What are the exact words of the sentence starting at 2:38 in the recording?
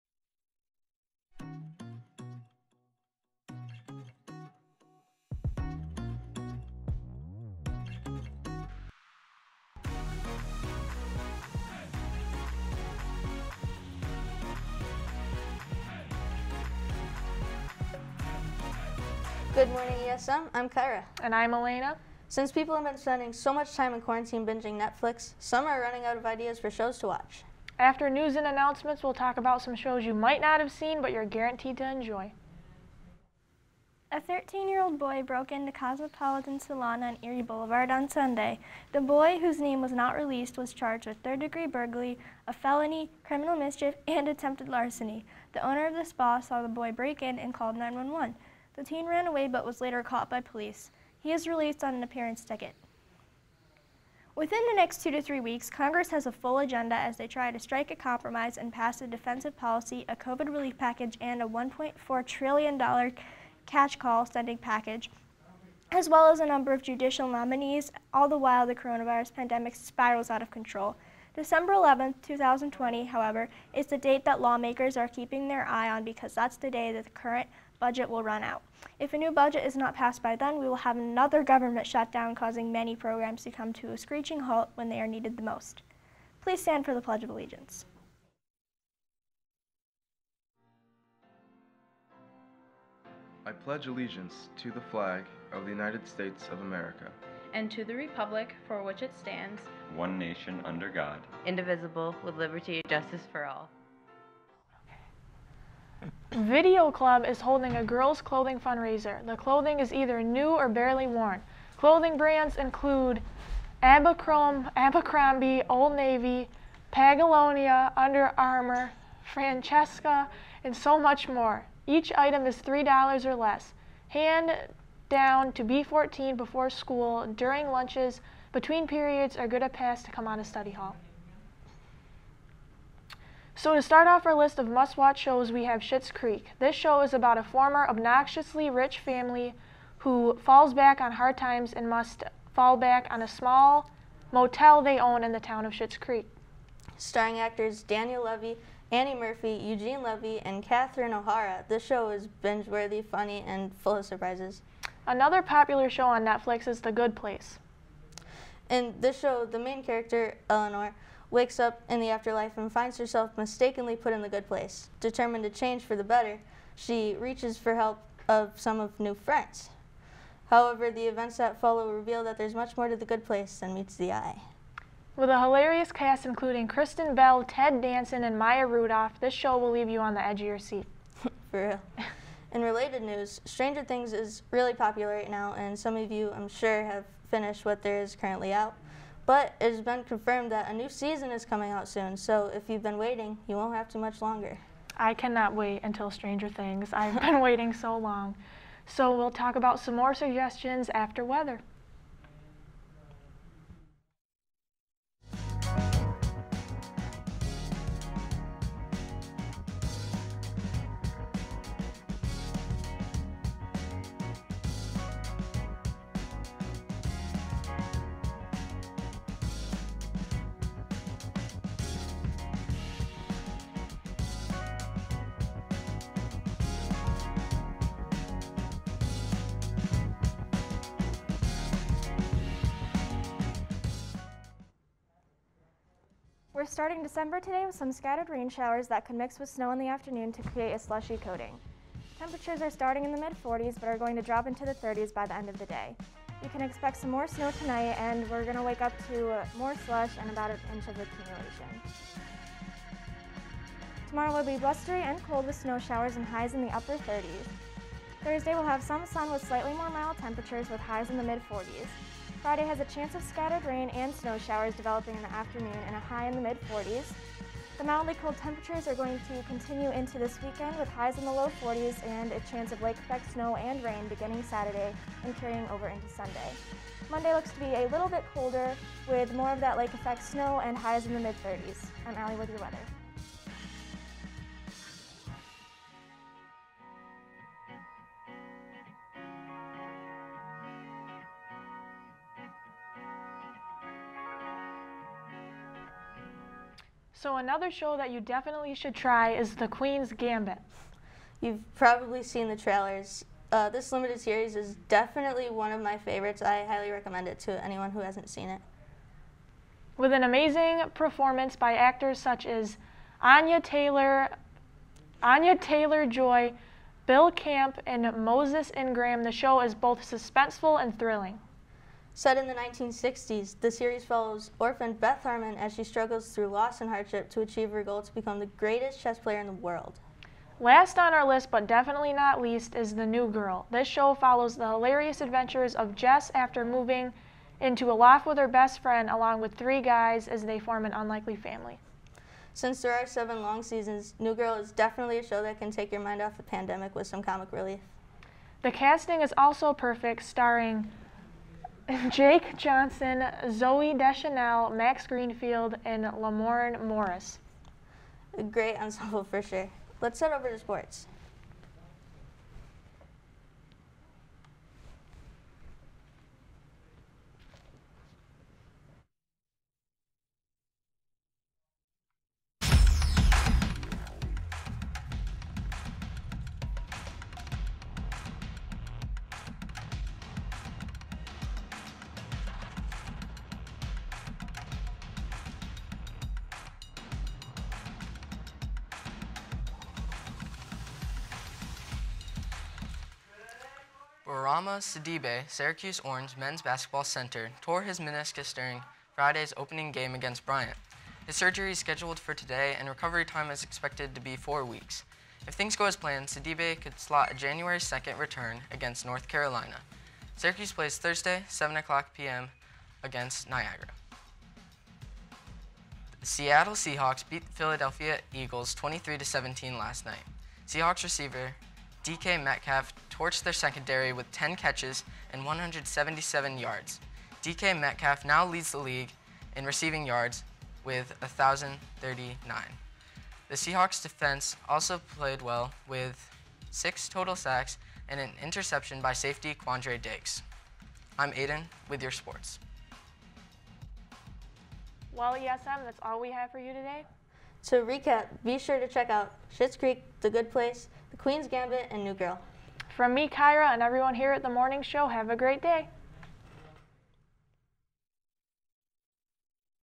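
In this show, the main character, Eleanor, wakes up in the afterlife and finds herself mistakenly put in the good place.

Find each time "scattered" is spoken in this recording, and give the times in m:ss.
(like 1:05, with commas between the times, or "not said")
3:57, 4:23.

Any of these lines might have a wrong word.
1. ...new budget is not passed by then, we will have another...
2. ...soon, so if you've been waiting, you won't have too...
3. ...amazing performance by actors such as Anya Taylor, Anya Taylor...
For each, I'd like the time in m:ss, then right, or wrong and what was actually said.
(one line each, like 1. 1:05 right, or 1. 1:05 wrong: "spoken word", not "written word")
1. 1:19 right
2. 3:11 right
3. 5:10 right.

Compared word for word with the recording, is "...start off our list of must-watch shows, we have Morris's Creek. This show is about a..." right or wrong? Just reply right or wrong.
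wrong.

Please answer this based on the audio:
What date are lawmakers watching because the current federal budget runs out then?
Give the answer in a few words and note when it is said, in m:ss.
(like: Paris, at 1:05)
December 11, 2020, at 1:11.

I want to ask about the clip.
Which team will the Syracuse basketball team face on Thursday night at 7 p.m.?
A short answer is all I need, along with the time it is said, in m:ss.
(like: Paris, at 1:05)
Niagara, at 6:53.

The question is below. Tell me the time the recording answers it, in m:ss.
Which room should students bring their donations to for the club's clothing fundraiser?
2:05.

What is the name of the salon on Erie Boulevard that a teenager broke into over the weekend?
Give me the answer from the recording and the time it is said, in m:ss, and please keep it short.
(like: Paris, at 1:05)
Cosmopolitan Salon, at 0:35.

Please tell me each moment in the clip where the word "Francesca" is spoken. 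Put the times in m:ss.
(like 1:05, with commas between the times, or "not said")
1:59.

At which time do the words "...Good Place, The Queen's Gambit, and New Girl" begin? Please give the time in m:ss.
7:30.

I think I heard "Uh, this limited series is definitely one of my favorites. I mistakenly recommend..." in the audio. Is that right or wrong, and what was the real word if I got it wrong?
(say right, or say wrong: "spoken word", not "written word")
wrong: "highly", not "mistakenly".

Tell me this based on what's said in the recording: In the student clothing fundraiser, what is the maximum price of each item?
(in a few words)
$3.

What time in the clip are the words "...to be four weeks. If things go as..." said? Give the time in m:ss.
6:44.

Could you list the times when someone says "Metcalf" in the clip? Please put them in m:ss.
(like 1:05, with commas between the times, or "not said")
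7:02, 7:07.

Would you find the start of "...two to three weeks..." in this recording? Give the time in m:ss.
0:55.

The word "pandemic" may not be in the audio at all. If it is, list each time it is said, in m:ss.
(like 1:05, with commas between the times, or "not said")
1:09, 5:46.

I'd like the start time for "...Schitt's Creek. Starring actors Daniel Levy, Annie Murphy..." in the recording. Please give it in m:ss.
2:25.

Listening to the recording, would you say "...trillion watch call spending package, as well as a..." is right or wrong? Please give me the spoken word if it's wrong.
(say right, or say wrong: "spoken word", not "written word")
wrong: "catch", not "watch".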